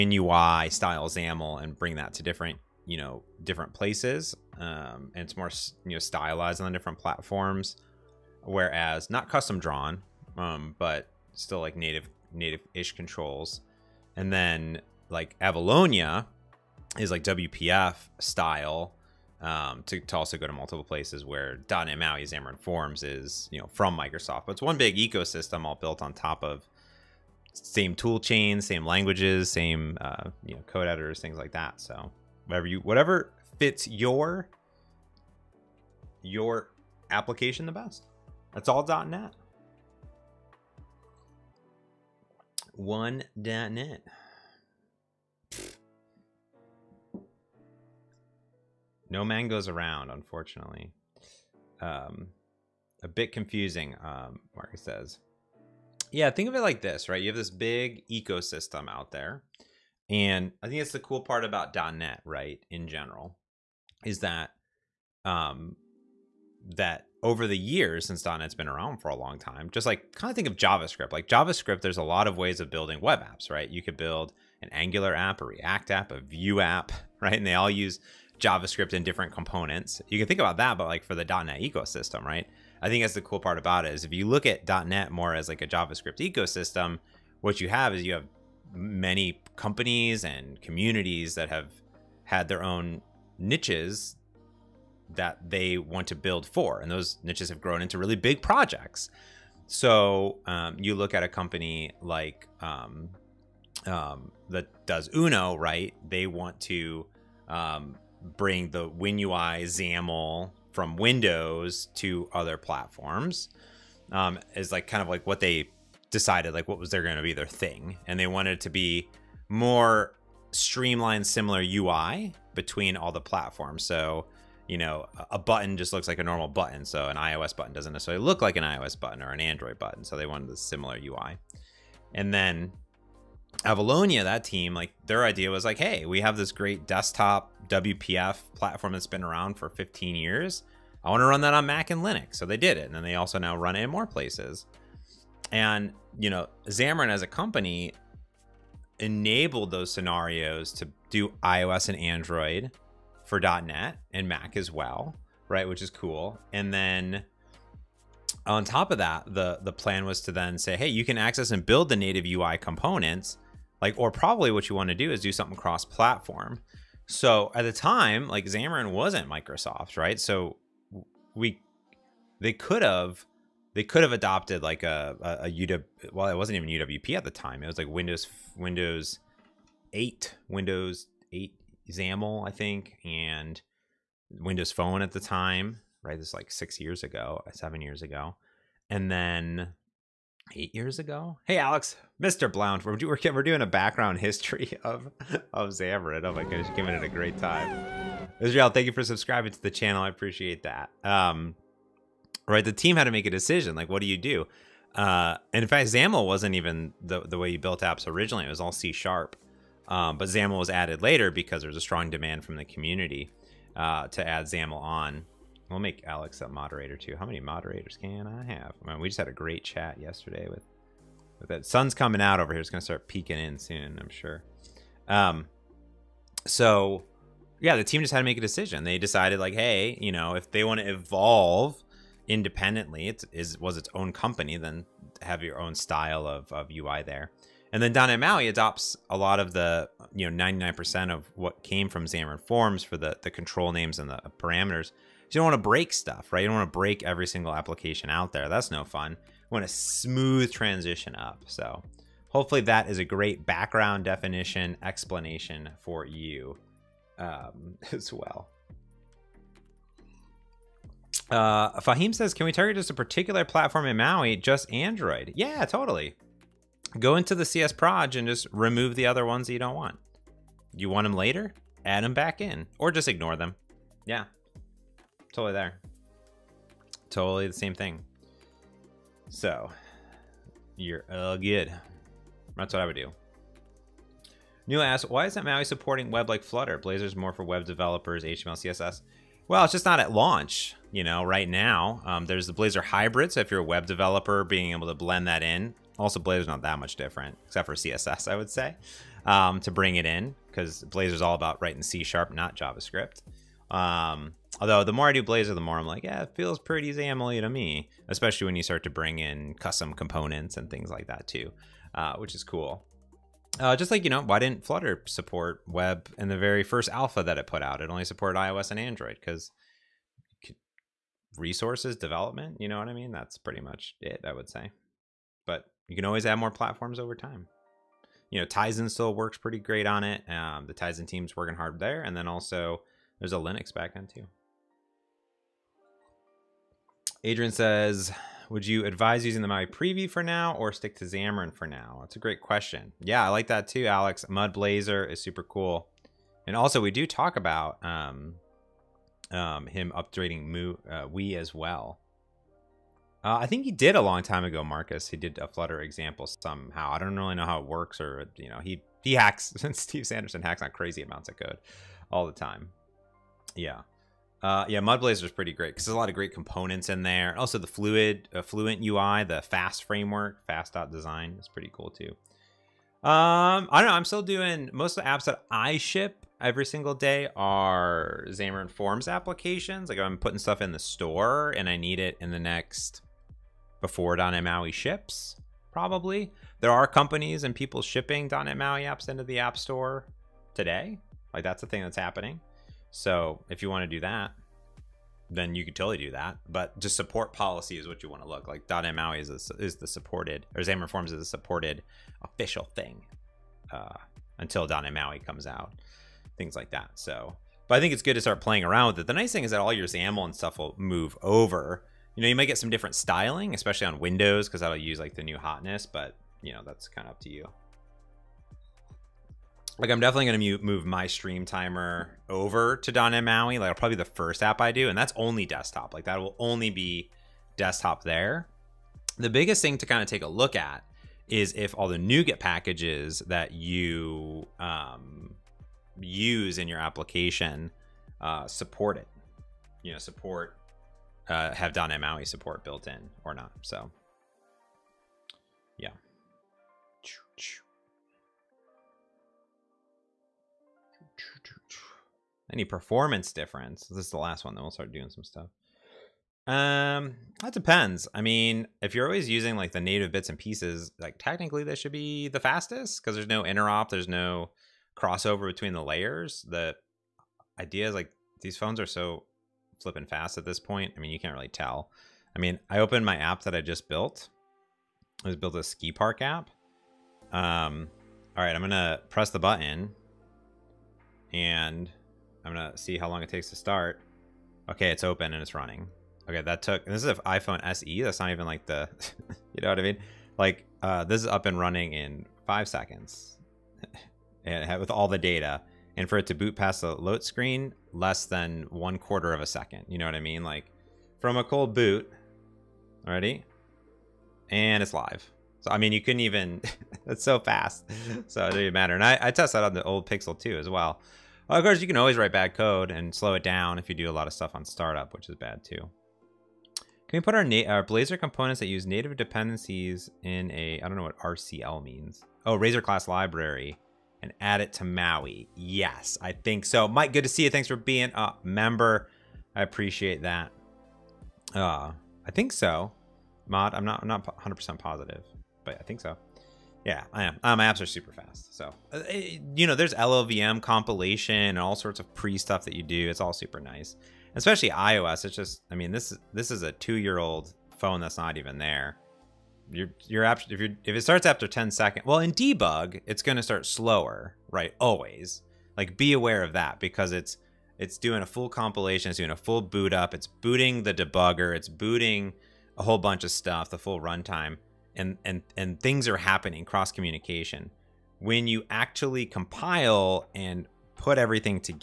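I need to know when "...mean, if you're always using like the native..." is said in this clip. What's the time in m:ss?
7:38.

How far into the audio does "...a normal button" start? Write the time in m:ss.
2:06.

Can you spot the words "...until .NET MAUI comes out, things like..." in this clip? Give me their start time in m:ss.
6:44.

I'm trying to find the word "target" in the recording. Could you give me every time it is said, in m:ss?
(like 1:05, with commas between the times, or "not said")
4:22.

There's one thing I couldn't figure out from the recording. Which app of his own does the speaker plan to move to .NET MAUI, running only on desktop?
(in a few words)
stream timer.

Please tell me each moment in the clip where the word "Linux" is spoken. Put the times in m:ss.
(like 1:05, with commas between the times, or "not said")
2:22, 5:33.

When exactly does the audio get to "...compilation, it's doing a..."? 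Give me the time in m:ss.
9:18.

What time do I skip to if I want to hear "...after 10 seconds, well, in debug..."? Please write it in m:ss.
9:11.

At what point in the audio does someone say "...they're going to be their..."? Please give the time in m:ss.
1:56.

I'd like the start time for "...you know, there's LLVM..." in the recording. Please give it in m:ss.
8:59.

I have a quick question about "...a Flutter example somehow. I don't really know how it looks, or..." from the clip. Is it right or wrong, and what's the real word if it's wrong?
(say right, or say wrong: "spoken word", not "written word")
wrong: "works", not "looks".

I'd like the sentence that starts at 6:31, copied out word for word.
Like that's the thing that's happening.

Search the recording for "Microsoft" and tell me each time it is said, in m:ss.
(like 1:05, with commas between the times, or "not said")
0:23, 2:49.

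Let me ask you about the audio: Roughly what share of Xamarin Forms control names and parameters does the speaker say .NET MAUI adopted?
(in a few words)
99%.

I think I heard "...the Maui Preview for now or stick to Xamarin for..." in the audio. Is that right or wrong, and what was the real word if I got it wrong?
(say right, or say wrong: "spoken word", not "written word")
right.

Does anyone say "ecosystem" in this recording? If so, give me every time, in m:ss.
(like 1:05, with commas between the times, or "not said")
0:24, 0:58, 1:21, 1:26.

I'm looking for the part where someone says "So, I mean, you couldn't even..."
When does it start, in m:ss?
8:25.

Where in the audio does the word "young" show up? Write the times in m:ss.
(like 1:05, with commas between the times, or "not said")
not said.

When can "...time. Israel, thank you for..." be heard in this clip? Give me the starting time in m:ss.
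3:17.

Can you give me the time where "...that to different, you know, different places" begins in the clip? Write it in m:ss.
0:01.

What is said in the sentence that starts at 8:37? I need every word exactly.
Can we put our, our Blazor components that use native dependencies in a, I don't know what RCL means.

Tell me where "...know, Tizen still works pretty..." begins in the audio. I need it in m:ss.
5:28.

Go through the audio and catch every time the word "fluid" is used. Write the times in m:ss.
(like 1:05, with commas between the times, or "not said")
6:07.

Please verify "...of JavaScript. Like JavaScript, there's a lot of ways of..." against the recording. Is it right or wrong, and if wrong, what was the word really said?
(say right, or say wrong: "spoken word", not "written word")
right.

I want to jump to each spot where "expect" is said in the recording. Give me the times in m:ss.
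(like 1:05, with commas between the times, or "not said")
not said.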